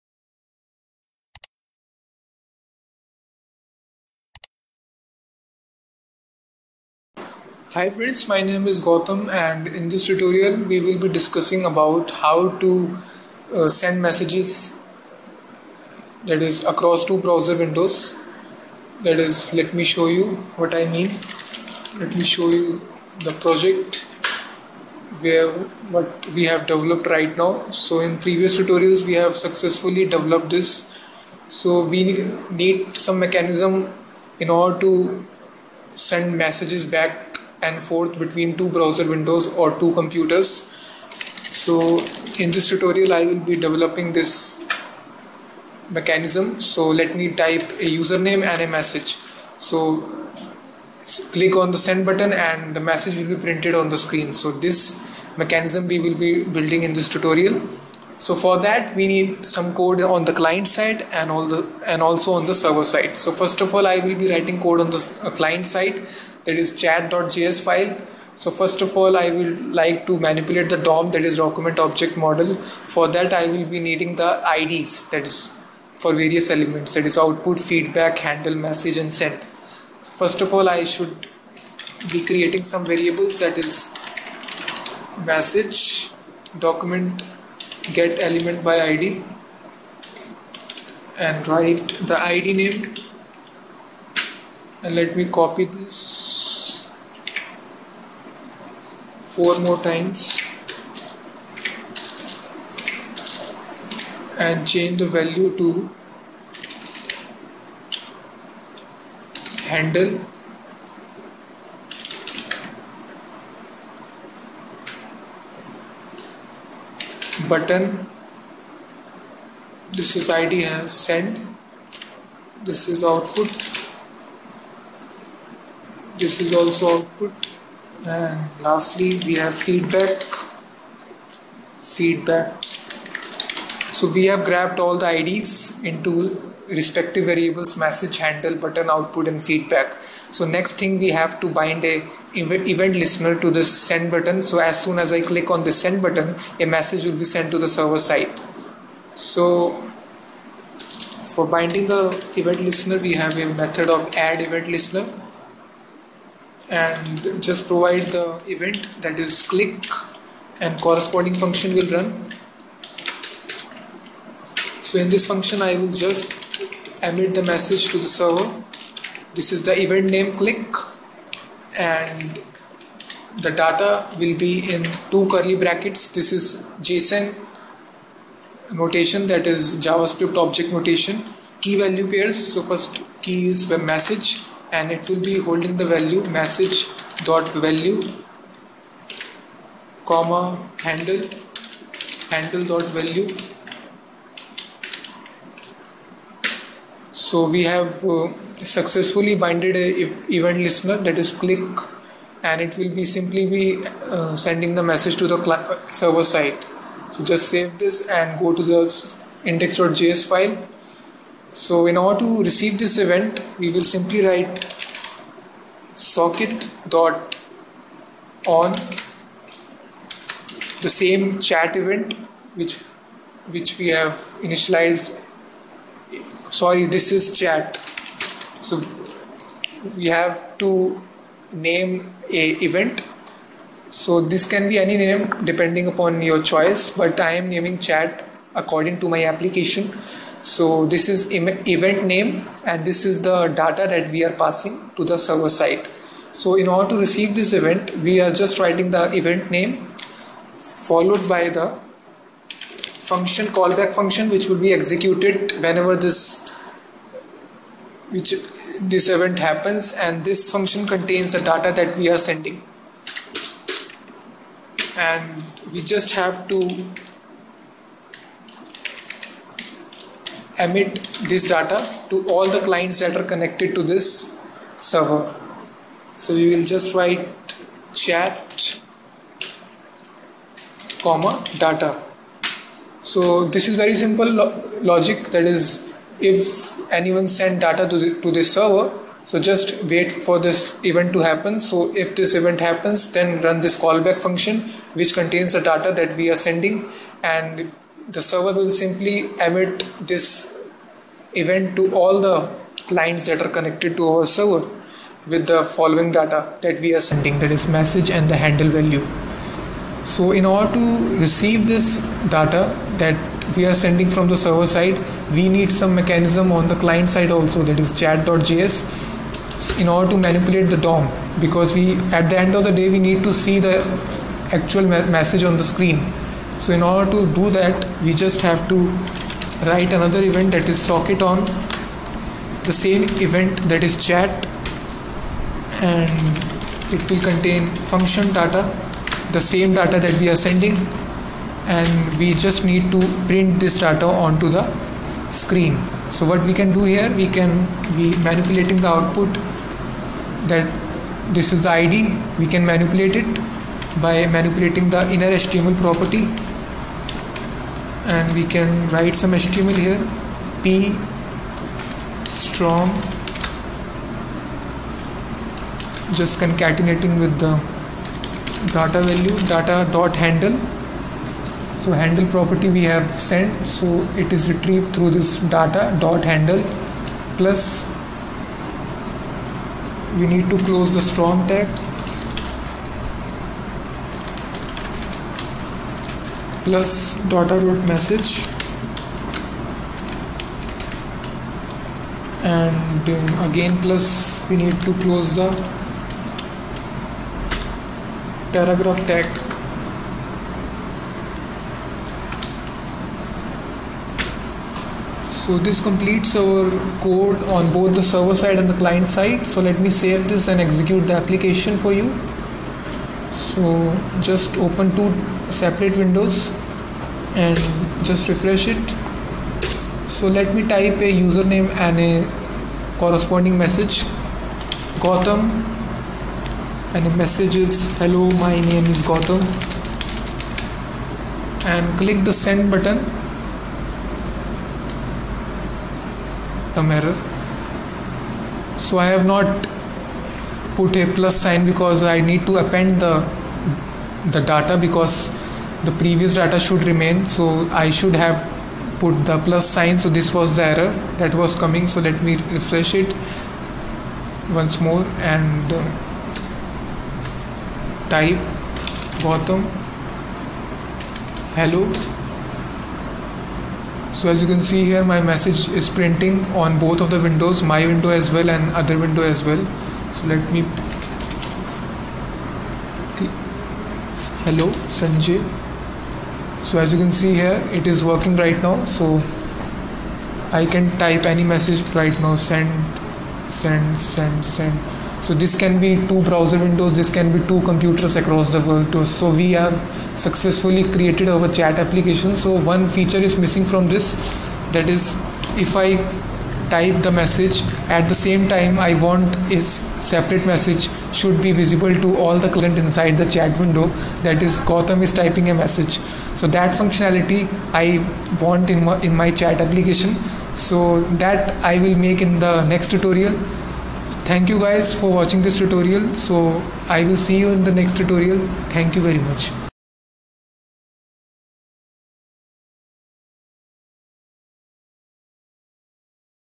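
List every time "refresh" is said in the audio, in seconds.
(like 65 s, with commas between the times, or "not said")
418 s, 452 s.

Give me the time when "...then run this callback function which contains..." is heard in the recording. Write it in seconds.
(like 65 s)
293 s.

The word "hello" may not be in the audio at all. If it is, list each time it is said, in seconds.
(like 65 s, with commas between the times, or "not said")
427 s, 461 s, 474 s.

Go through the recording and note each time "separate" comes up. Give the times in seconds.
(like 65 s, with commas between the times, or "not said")
415 s, 499 s.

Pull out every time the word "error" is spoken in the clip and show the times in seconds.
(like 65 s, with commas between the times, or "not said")
436 s, 450 s.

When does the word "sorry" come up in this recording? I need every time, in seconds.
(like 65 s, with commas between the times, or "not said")
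226 s.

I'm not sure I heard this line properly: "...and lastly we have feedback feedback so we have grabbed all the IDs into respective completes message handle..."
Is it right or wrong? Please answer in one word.
wrong.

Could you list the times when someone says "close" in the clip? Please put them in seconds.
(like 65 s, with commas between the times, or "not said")
380 s, 395 s.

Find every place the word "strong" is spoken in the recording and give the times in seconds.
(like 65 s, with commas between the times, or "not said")
362 s, 381 s.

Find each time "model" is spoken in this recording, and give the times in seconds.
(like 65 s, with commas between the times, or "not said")
72 s.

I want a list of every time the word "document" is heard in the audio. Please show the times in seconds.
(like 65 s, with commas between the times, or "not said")
71 s, 86 s.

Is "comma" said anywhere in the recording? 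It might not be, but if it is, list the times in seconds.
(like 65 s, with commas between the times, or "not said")
190 s, 281 s.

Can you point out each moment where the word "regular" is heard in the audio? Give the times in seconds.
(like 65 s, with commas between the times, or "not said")
not said.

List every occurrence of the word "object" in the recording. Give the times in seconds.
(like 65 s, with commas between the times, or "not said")
71 s, 180 s.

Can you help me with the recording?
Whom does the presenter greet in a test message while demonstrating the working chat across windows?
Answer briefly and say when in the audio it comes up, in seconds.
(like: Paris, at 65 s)
Sanjay, at 474 s.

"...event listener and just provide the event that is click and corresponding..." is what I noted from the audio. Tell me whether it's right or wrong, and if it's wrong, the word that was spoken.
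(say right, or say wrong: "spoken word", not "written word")
right.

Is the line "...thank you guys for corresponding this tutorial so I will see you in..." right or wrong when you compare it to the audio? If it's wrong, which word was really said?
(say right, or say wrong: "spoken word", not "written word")
wrong: "watching", not "corresponding".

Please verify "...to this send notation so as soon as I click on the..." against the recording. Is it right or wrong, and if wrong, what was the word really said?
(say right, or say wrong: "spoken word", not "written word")
wrong: "button", not "notation".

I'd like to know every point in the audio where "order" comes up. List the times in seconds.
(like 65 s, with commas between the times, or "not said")
34 s, 211 s, 246 s, 310 s, 319 s, 326 s.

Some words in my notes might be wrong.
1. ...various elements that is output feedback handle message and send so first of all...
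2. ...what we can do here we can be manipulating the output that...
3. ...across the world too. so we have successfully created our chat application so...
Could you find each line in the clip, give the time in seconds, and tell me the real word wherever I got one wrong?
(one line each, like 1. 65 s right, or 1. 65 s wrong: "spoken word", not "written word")
1. 76 s right
2. 346 s right
3. 488 s right.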